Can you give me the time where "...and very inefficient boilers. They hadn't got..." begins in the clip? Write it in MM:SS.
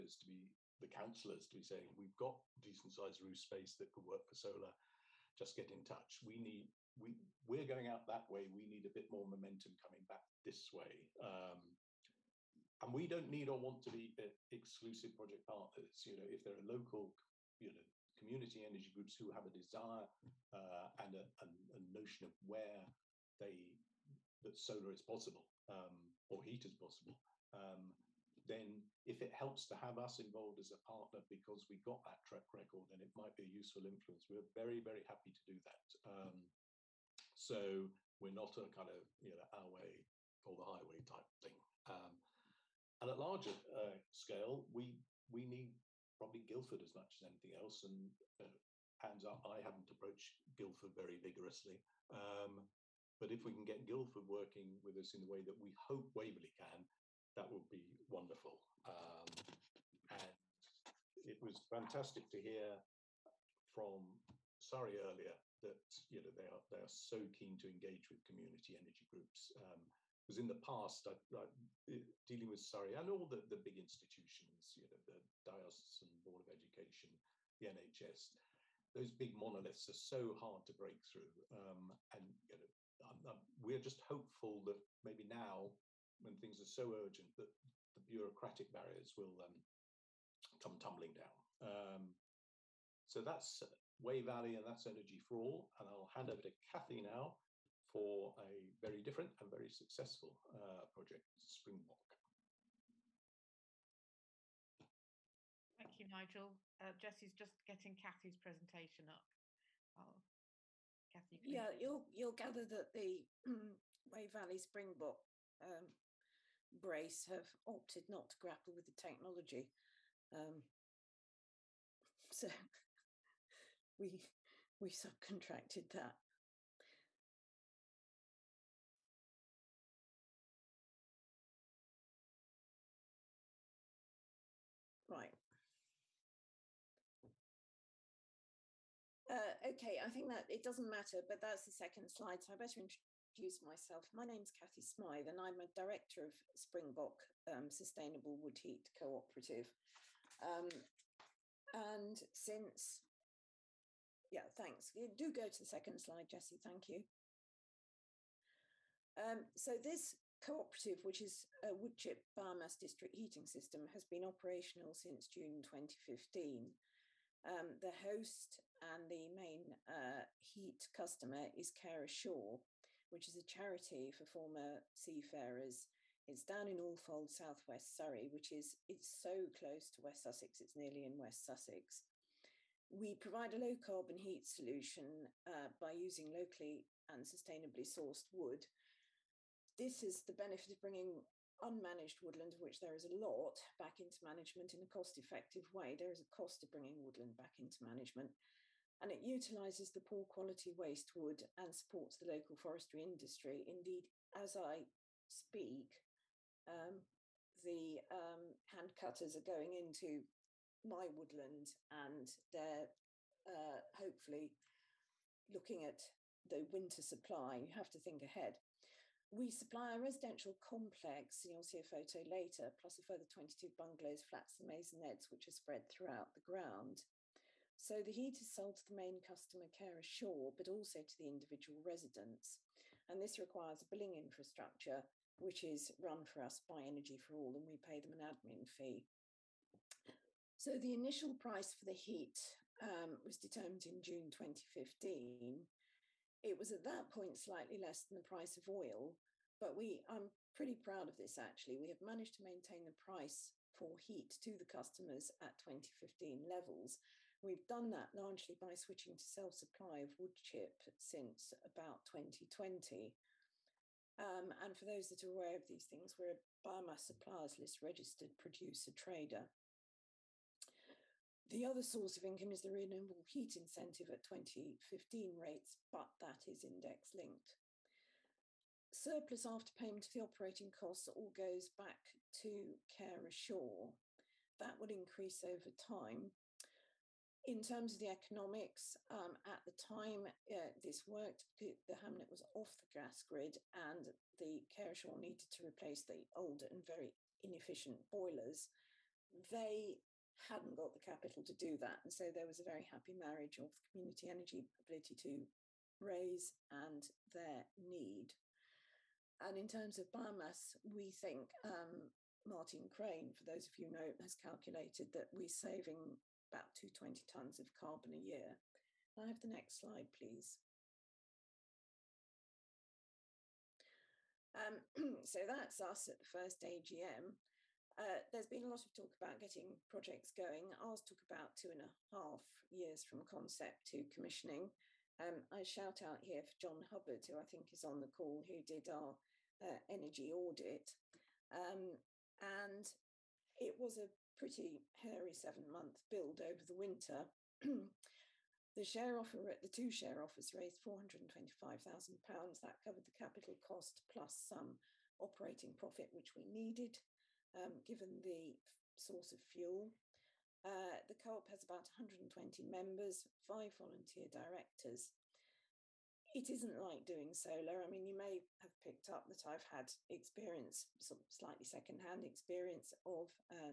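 04:56.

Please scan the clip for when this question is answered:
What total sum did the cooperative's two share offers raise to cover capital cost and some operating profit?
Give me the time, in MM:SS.
05:50.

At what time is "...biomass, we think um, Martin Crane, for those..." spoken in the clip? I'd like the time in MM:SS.
05:10.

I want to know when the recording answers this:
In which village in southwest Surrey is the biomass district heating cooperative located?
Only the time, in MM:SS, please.
02:56.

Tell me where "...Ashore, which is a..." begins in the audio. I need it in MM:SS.
02:52.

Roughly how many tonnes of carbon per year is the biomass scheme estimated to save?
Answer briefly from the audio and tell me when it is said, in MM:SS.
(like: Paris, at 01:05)
220 tonnes, at 05:16.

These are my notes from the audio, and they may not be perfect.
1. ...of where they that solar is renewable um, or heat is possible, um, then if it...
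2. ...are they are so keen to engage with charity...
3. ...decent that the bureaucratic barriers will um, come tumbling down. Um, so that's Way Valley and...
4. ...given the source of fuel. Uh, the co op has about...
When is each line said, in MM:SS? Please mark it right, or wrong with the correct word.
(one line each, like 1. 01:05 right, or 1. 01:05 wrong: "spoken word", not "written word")
1. 00:22 wrong: "possible", not "renewable"
2. 01:06 wrong: "community", not "charity"
3. 01:26 wrong: "urgent", not "decent"
4. 05:57 right.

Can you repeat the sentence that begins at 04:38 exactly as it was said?
Surplus after payment of the operating costs all goes back to care ashore.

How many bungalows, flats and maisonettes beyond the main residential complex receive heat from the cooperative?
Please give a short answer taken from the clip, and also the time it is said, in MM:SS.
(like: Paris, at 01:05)
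22, at 03:43.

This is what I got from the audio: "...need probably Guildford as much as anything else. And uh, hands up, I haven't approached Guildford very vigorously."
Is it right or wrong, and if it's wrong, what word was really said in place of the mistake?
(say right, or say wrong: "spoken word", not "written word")
right.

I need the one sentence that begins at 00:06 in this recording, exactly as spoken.
We need, we, we're going out that way.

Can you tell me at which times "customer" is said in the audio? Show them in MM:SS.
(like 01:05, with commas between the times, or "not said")
02:50, 03:49, 04:14.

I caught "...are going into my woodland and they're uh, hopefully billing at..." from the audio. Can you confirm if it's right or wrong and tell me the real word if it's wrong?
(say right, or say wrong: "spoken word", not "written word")
wrong: "looking", not "billing".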